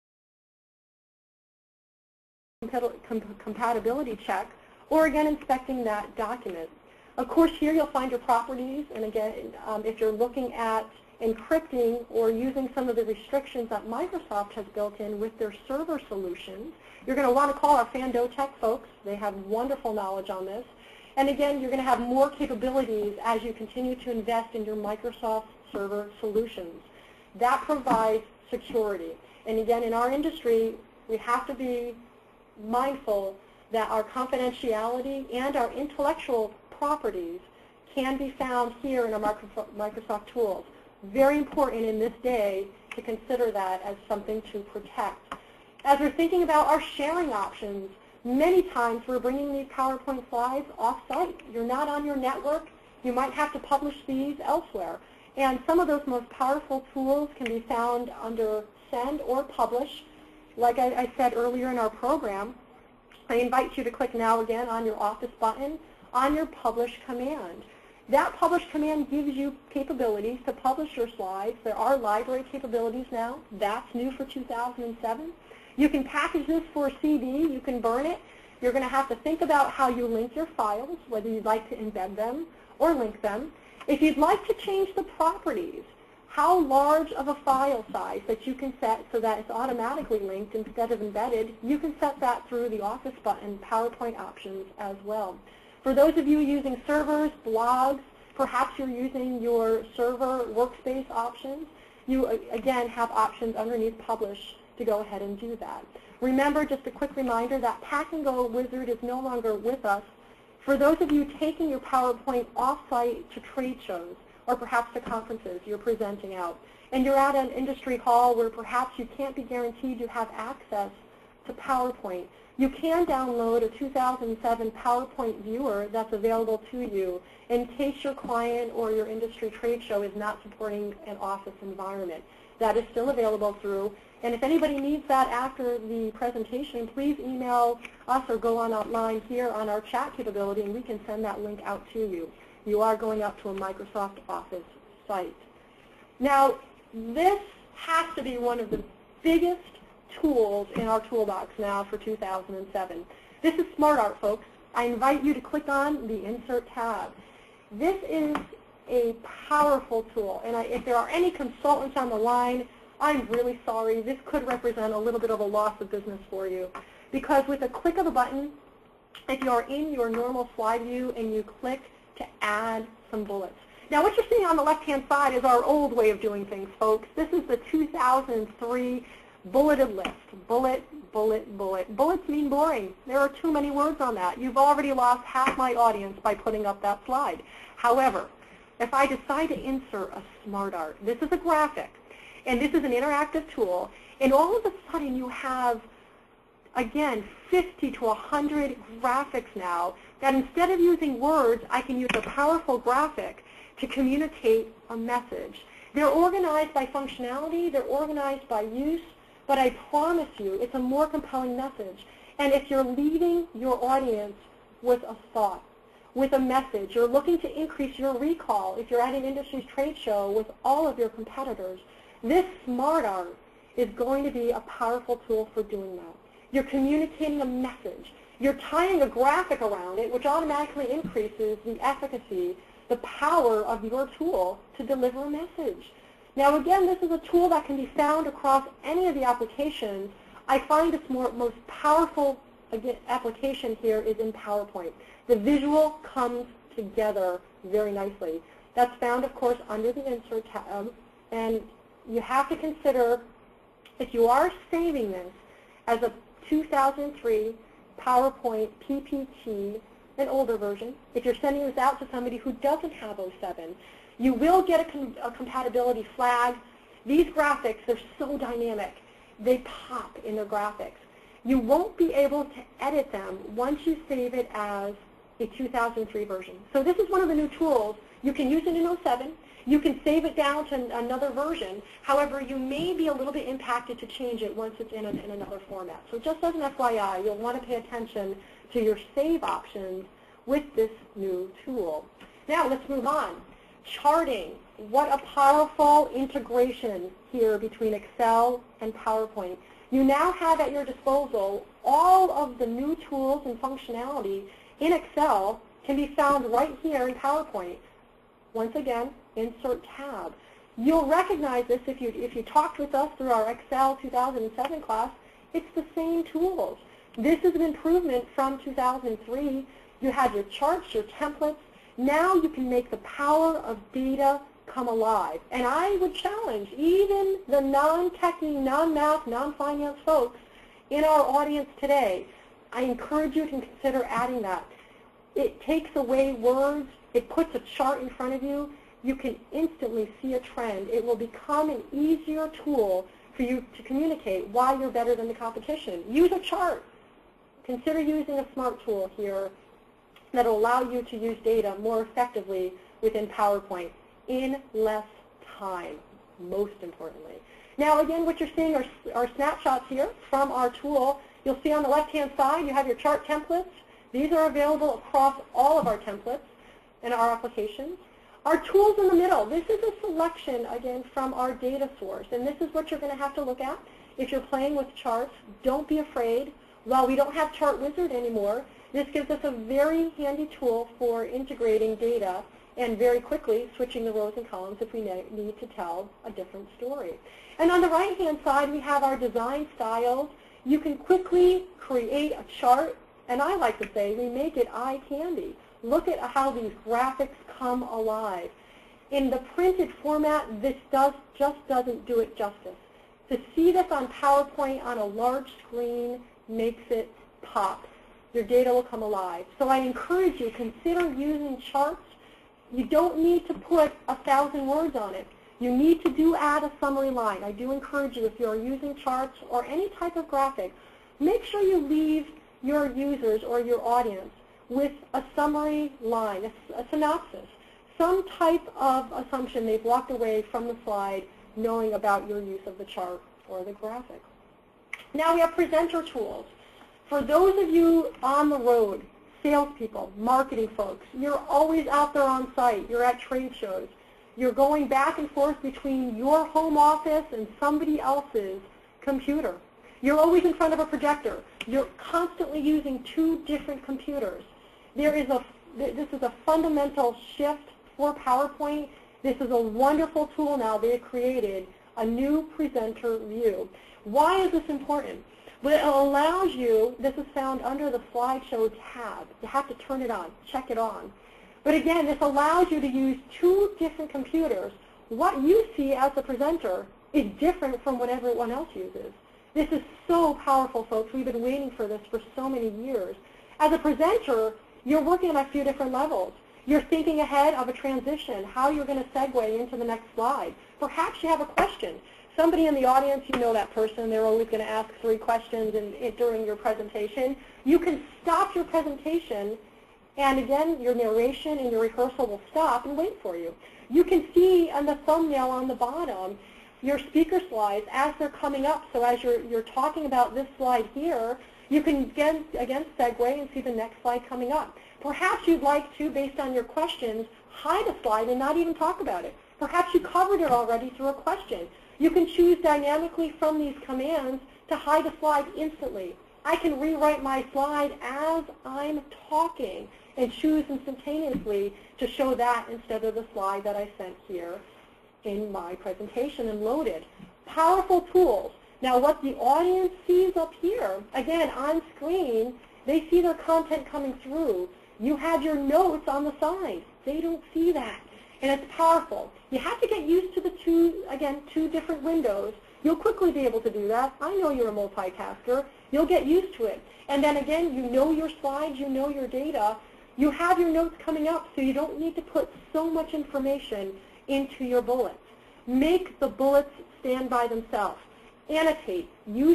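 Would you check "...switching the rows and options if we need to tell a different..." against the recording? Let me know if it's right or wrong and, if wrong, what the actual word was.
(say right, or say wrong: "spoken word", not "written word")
wrong: "columns", not "options".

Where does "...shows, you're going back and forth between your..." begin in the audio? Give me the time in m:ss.
7:23.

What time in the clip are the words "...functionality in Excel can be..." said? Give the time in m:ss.
5:03.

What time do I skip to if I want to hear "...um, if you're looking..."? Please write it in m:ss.
0:09.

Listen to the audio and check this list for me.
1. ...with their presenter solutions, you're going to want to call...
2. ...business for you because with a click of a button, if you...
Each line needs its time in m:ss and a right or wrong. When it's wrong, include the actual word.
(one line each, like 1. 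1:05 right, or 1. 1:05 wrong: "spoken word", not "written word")
1. 0:15 wrong: "server", not "presenter"
2. 2:45 right.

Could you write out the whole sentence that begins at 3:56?
Now again, this is a tool that can be found across any of the applications.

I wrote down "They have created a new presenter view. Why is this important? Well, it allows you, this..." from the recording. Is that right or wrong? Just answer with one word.
right.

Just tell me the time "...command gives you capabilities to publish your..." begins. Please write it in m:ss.
1:08.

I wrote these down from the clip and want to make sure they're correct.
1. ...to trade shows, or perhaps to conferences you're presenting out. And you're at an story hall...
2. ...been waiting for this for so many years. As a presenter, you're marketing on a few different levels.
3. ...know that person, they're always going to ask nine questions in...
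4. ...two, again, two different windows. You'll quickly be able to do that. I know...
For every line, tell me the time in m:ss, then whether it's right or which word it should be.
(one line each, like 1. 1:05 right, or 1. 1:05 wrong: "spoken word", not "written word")
1. 1:53 wrong: "industry", not "story"
2. 8:01 wrong: "working", not "marketing"
3. 8:13 wrong: "three", not "nine"
4. 9:10 right.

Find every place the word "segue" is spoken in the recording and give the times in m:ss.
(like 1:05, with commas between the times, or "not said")
8:09, 8:32.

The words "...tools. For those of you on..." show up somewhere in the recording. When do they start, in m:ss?
7:16.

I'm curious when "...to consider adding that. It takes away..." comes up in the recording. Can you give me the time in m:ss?
5:33.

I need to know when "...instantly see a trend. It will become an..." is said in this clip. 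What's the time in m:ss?
5:39.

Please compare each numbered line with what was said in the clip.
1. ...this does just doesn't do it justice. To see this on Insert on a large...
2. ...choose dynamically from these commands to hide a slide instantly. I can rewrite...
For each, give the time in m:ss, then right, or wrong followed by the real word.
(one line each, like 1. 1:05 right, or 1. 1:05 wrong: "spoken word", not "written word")
1. 6:40 wrong: "PowerPoint", not "Insert"
2. 8:42 right.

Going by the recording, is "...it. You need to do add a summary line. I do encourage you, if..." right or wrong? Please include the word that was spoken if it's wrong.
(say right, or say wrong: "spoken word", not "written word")
right.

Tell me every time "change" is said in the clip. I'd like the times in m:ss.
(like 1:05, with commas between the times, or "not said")
1:24, 4:44.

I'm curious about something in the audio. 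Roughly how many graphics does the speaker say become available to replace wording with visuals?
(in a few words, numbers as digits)
50 to 100.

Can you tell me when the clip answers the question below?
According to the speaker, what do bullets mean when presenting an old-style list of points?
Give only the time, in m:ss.
3:01.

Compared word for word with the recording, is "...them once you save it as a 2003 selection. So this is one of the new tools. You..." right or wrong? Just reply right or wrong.
wrong.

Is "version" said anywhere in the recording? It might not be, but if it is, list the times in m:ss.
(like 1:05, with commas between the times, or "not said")
4:20, 4:36, 4:41.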